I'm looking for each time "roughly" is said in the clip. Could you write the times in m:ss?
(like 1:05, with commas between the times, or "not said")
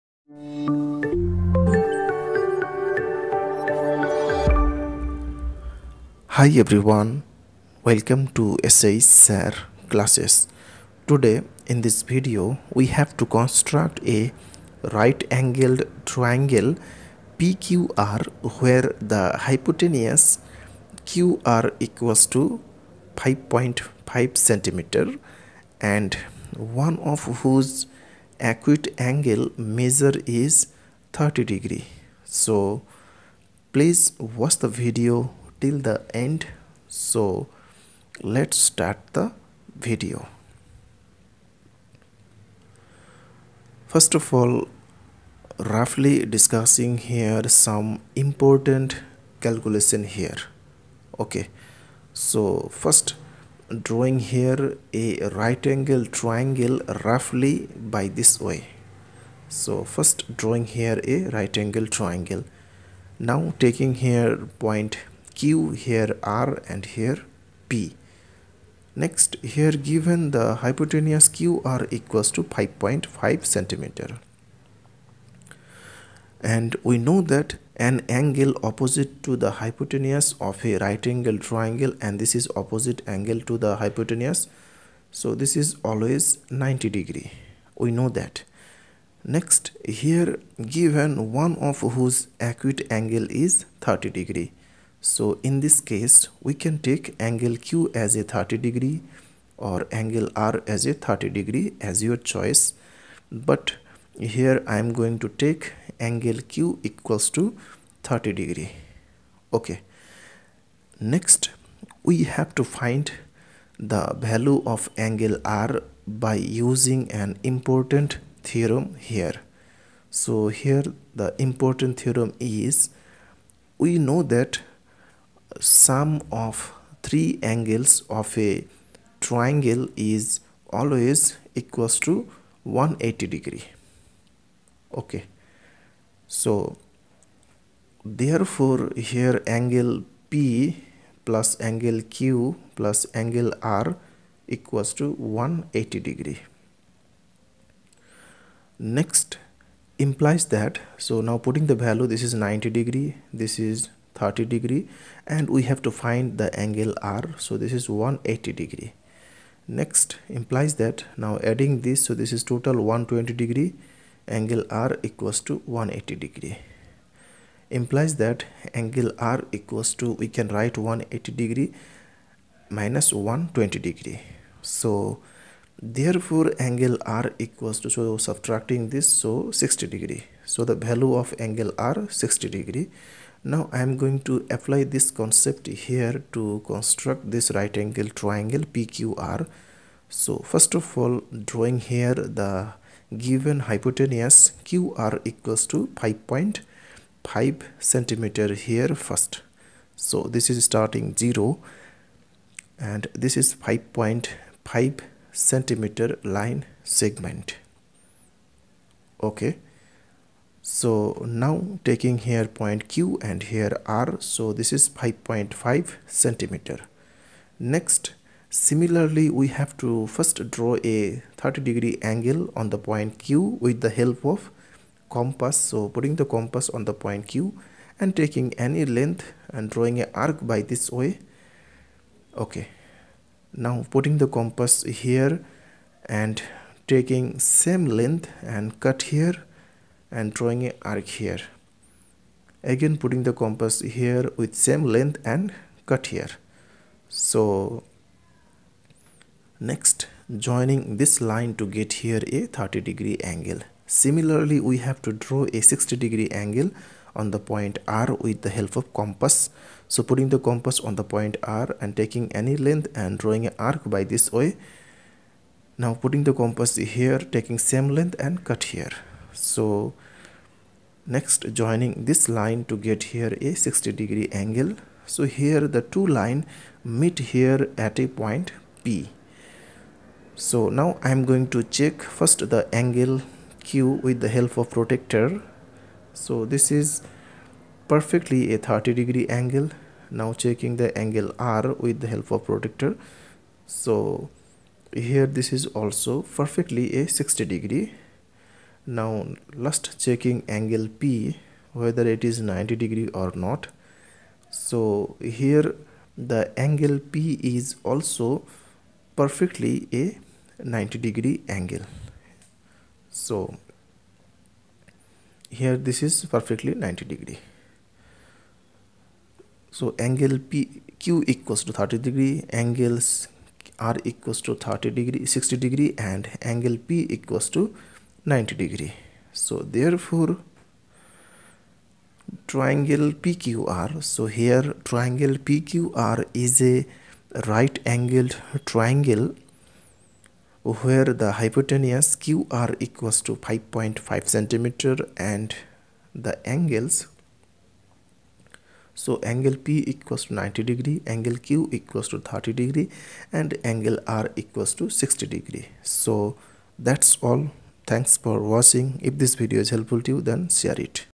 0:45, 0:57.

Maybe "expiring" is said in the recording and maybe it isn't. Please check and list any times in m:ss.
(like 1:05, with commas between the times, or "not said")
not said.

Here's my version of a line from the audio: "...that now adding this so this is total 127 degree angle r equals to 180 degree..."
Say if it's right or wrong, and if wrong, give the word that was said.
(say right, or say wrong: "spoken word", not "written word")
wrong: "120", not "127".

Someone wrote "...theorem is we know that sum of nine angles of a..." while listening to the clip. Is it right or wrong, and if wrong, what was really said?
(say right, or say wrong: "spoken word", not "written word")
wrong: "three", not "nine".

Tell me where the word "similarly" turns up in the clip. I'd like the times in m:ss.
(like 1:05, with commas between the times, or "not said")
3:38, 4:13.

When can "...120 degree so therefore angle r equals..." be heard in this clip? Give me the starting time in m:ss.
2:53.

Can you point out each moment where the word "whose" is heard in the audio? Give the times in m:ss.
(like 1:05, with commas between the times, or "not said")
0:27, 1:31.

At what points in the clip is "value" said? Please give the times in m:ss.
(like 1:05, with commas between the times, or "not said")
1:54, 2:31, 3:00.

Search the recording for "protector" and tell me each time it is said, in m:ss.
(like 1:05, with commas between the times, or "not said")
4:44, 4:52.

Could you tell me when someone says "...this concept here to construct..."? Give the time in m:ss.
3:04.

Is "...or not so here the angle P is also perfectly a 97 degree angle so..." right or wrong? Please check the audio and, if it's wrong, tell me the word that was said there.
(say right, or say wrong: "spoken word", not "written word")
wrong: "90", not "97".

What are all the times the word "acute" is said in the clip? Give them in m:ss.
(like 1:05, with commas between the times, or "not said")
0:28, 1:32.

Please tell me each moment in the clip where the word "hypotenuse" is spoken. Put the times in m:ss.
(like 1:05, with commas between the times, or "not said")
0:19, 1:10, 1:19, 1:23, 3:13, 5:41.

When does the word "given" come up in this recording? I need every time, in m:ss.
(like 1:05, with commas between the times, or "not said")
1:09, 1:30, 3:13.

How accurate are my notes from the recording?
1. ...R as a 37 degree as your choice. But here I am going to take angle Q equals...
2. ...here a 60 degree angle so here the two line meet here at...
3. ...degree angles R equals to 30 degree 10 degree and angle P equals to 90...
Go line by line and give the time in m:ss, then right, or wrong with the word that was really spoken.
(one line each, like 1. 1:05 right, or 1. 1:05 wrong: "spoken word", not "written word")
1. 1:40 wrong: "30", not "37"
2. 4:33 right
3. 5:22 wrong: "60", not "10".